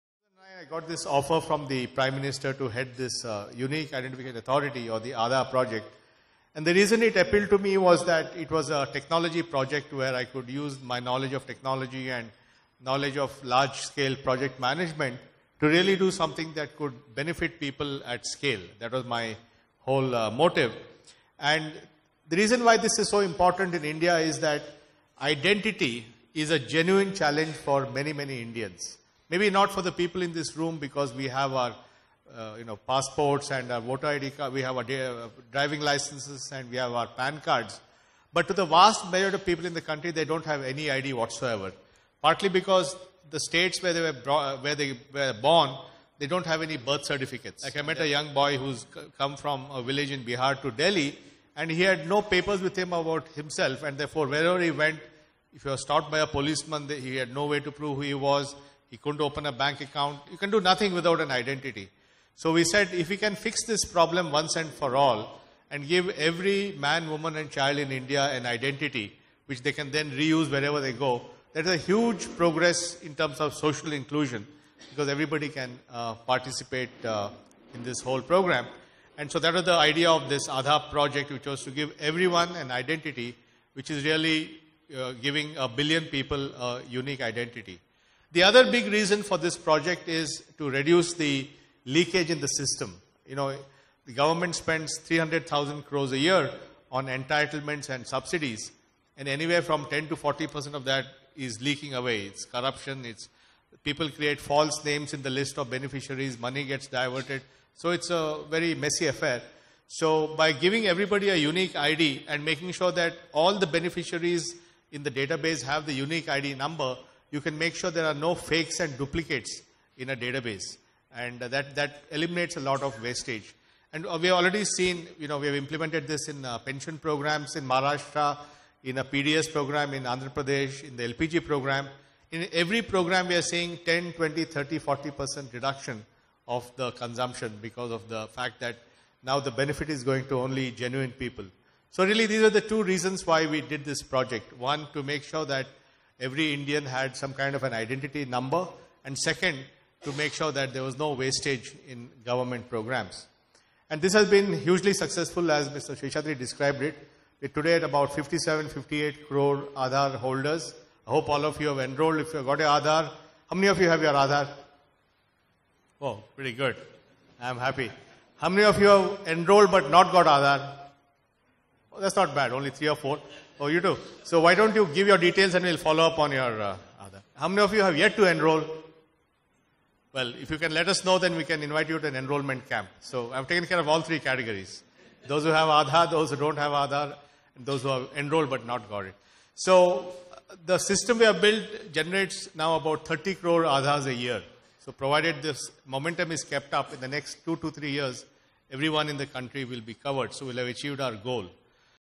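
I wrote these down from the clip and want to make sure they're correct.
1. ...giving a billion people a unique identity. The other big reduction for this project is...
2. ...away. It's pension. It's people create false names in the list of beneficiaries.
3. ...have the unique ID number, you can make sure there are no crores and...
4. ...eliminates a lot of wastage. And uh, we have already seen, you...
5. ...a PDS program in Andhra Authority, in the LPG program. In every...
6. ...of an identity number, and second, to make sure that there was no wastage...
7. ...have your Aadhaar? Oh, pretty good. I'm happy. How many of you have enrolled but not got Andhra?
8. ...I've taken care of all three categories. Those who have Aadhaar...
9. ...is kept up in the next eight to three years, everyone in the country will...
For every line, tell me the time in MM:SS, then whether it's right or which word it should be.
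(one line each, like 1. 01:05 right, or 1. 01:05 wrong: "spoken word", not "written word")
1. 01:25 wrong: "reason", not "reduction"
2. 01:41 wrong: "corruption", not "pension"
3. 01:55 wrong: "fakes", not "crores"
4. 02:02 right
5. 02:08 wrong: "Pradesh", not "Authority"
6. 02:27 right
7. 02:43 wrong: "Aadhaar", not "Andhra"
8. 03:03 right
9. 03:16 wrong: "two", not "eight".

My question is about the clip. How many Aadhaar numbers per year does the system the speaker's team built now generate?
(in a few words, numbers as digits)
30 crore.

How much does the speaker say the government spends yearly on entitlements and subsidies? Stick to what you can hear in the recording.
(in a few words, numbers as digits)
300,000 crores.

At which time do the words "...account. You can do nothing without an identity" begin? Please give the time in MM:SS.
00:59.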